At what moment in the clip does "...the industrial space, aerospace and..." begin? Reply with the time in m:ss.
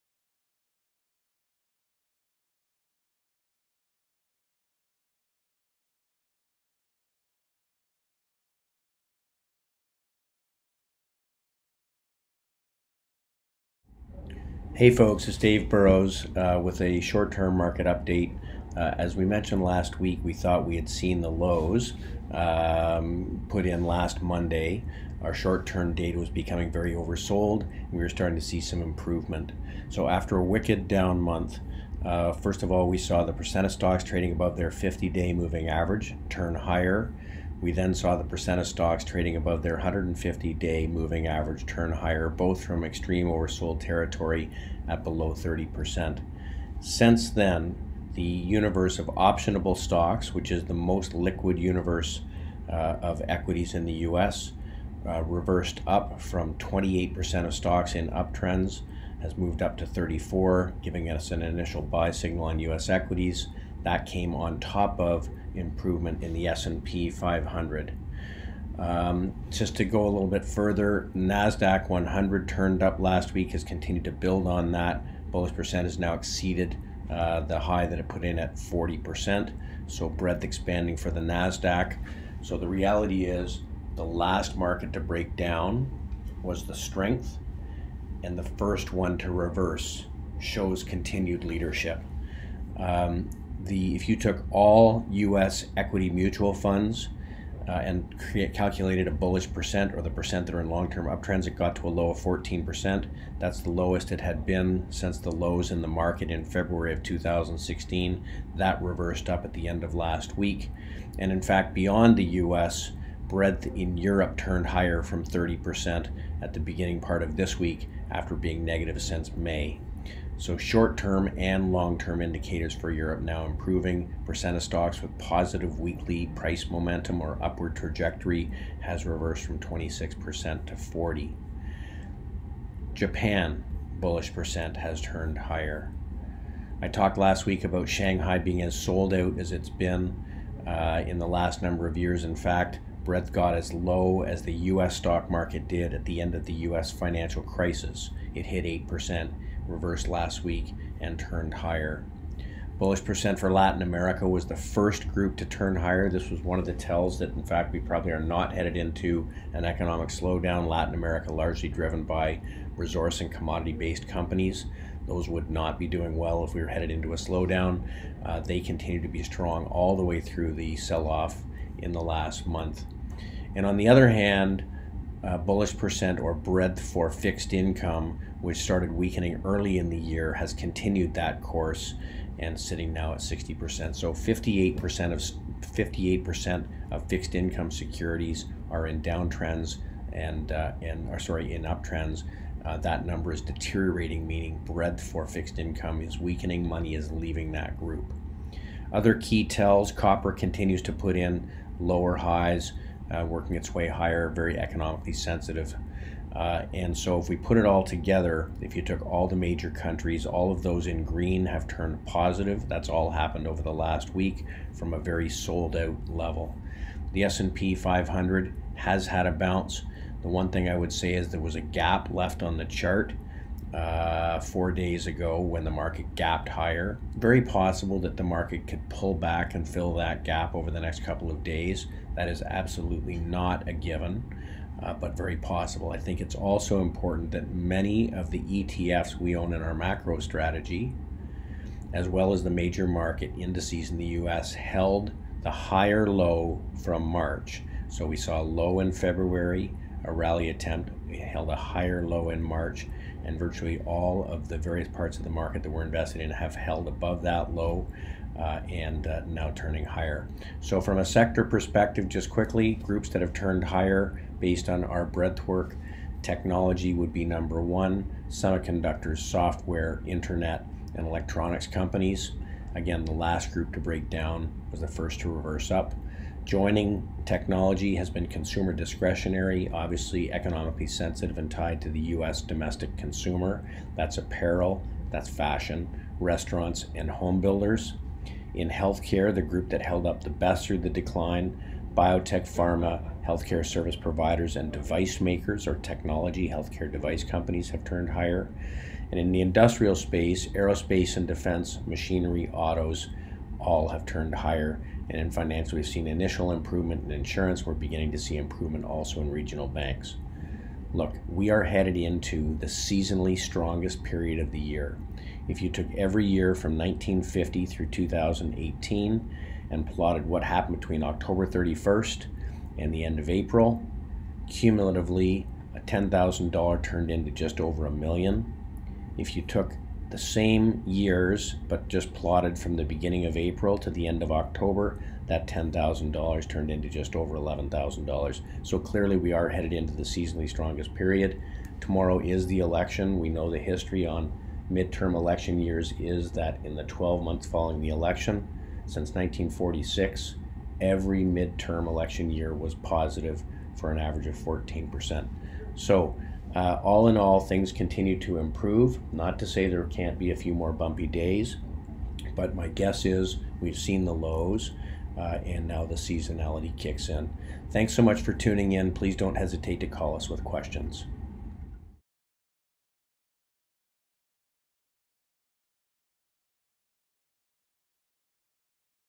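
4:59.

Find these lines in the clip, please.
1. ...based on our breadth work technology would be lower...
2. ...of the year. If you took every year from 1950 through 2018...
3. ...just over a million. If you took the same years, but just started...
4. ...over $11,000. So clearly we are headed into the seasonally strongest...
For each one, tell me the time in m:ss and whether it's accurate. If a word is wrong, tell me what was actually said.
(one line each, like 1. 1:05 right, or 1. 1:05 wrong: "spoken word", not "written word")
1. 4:24 wrong: "number", not "lower"
2. 5:14 right
3. 5:27 wrong: "plotted", not "started"
4. 5:37 right.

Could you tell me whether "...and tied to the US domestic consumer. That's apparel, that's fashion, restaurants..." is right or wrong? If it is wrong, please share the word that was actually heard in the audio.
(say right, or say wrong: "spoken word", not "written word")
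right.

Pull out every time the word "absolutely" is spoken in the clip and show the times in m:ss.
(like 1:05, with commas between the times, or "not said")
3:52.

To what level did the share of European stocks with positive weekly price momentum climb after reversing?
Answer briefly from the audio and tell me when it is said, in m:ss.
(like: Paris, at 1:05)
40%, at 2:10.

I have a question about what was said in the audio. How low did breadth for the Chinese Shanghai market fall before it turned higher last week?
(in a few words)
8%.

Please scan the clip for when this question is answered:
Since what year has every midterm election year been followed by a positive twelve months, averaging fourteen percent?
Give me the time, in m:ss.
5:49.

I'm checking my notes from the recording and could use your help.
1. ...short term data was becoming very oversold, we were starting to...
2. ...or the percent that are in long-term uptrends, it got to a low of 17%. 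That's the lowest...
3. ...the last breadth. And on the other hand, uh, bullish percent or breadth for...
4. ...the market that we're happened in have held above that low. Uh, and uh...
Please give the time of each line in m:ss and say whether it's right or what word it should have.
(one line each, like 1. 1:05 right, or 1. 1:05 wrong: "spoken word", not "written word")
1. 0:25 right
2. 1:39 wrong: "14", not "17"
3. 2:51 wrong: "month", not "breadth"
4. 4:15 wrong: "invested", not "happened".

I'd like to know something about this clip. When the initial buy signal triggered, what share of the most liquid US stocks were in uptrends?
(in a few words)
34%.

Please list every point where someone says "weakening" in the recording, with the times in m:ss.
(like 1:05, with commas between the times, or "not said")
2:58, 3:16.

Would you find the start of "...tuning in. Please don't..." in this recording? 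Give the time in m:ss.
6:08.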